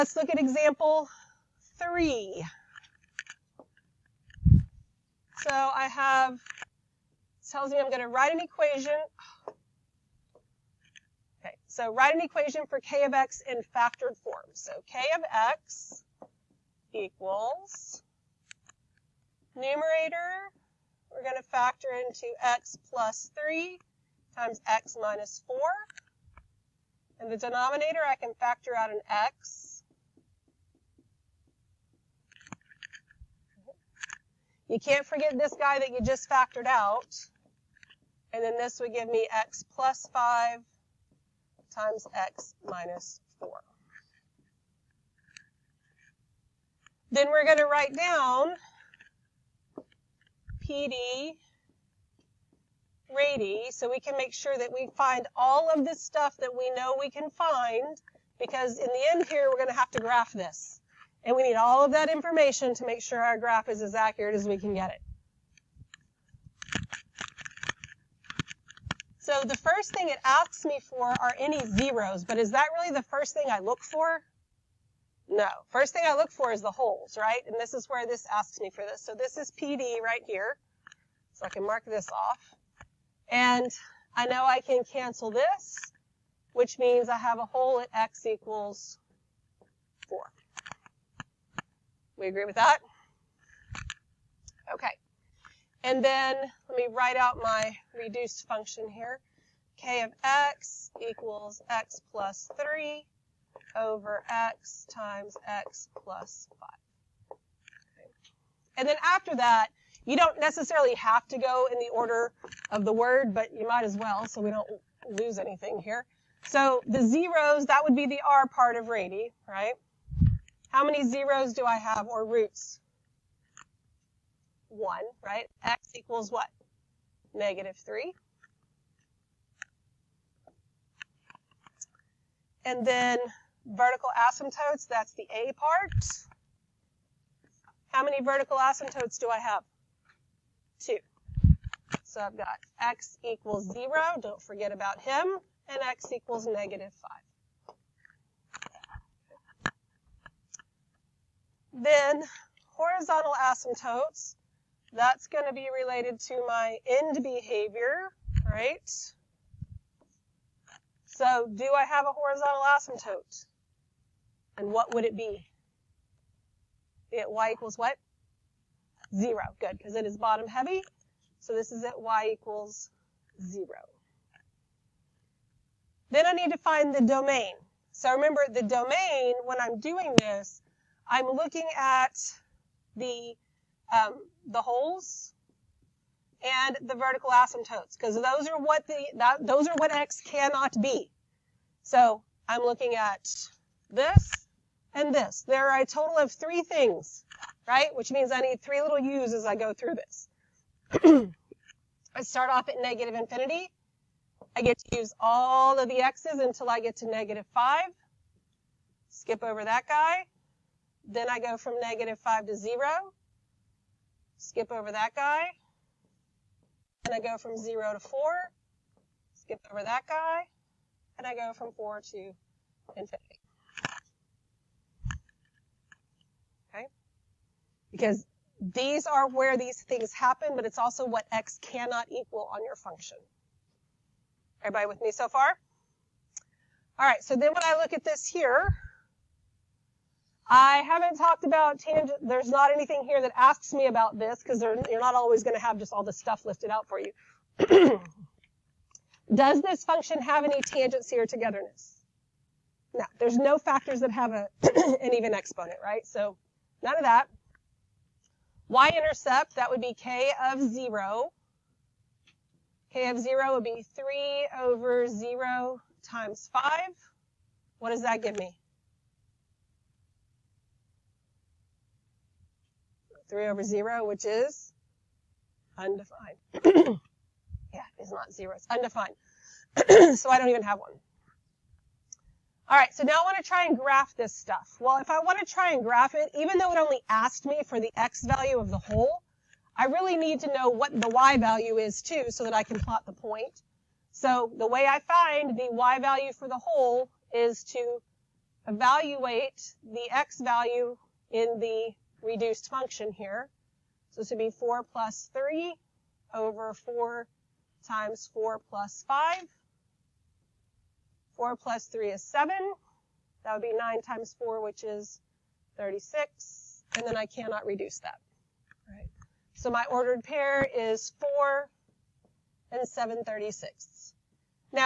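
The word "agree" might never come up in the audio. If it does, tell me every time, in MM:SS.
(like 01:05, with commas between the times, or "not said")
01:32.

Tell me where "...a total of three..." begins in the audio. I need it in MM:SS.
03:15.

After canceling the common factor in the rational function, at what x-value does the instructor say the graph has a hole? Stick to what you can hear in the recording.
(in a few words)
x = 4.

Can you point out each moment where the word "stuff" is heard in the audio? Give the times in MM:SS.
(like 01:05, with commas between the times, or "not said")
00:55, 04:06, 04:44.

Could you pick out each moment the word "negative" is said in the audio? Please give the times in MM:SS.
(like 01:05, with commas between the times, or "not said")
02:07, 02:26, 03:22, 03:27, 03:31.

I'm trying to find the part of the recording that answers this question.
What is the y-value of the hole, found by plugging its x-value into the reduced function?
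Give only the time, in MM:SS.
05:22.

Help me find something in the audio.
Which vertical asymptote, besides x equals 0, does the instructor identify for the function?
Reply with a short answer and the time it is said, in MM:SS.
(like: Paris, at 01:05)
x = -5, at 02:25.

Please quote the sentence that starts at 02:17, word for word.
How many vertical asymptotes do I have?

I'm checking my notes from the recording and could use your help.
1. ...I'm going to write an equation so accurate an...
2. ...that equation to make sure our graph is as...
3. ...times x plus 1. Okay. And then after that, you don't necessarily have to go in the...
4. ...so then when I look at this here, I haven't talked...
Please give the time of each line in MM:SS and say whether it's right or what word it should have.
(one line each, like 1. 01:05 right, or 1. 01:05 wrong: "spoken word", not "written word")
1. 00:07 wrong: "write", not "accurate"
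2. 01:01 wrong: "information", not "equation"
3. 01:44 wrong: "5", not "1"
4. 03:57 right.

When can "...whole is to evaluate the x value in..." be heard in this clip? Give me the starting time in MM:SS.
04:56.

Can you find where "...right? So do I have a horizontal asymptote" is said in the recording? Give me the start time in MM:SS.
02:38.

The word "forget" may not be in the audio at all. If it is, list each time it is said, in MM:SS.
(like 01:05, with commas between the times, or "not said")
00:35, 02:24.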